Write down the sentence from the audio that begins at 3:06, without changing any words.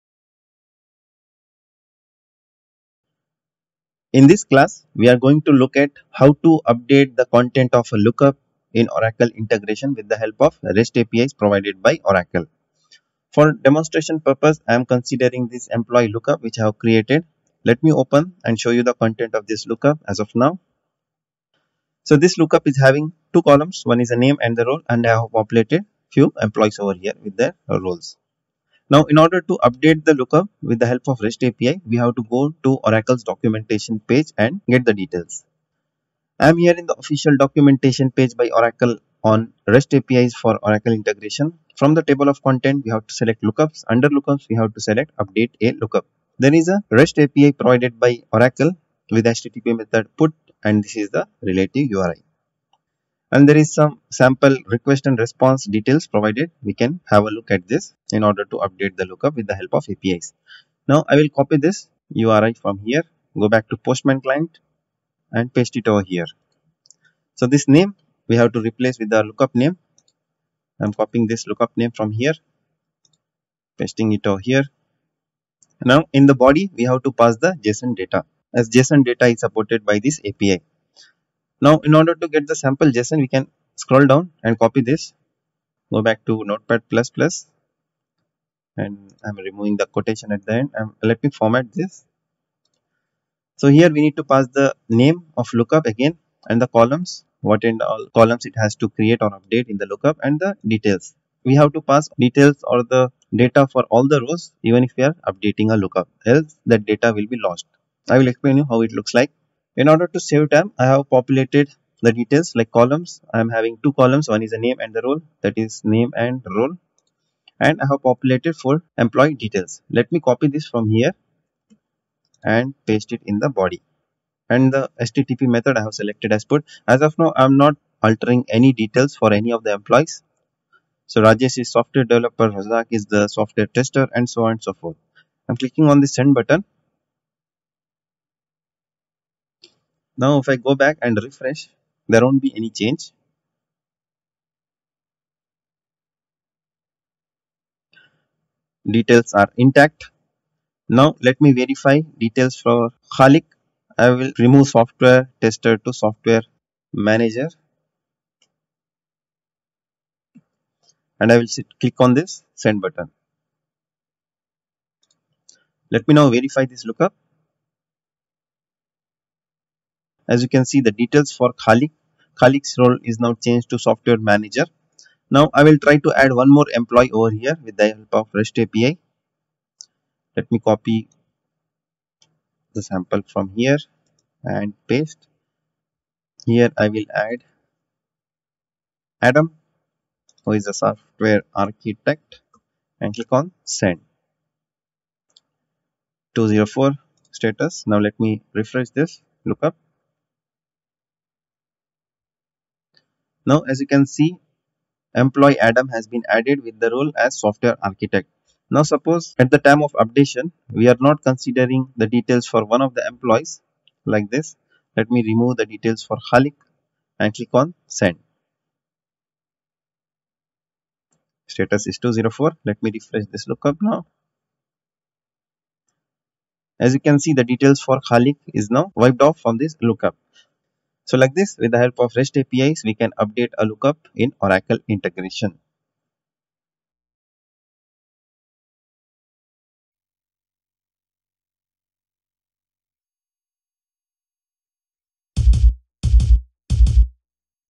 Here I will add Adam who is a software architect and click on send.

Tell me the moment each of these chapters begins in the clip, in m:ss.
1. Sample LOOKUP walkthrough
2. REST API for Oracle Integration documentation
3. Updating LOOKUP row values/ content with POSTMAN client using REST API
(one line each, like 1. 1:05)
1. 0:13
2. 0:35
3. 1:06.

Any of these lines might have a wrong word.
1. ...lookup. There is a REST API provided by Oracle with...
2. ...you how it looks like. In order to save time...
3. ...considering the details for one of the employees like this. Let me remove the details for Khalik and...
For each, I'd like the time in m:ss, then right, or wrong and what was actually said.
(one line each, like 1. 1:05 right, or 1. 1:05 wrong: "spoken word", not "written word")
1. 0:45 right
2. 1:48 right
3. 3:31 right.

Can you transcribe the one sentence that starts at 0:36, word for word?
I am here in the official documentation page by Oracle on REST APIs for Oracle integration.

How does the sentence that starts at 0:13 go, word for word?
For demonstration purpose, I am considering this employee lookup which I have created.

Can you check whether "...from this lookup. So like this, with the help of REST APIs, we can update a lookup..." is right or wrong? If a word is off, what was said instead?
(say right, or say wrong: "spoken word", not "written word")
right.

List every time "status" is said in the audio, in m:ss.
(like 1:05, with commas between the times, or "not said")
3:17, 3:41.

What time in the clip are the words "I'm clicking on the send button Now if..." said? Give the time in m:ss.
2:15.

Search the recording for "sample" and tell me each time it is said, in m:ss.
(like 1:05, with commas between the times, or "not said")
0:54, 1:22, 3:02.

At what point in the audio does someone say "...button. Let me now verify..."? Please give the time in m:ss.
2:42.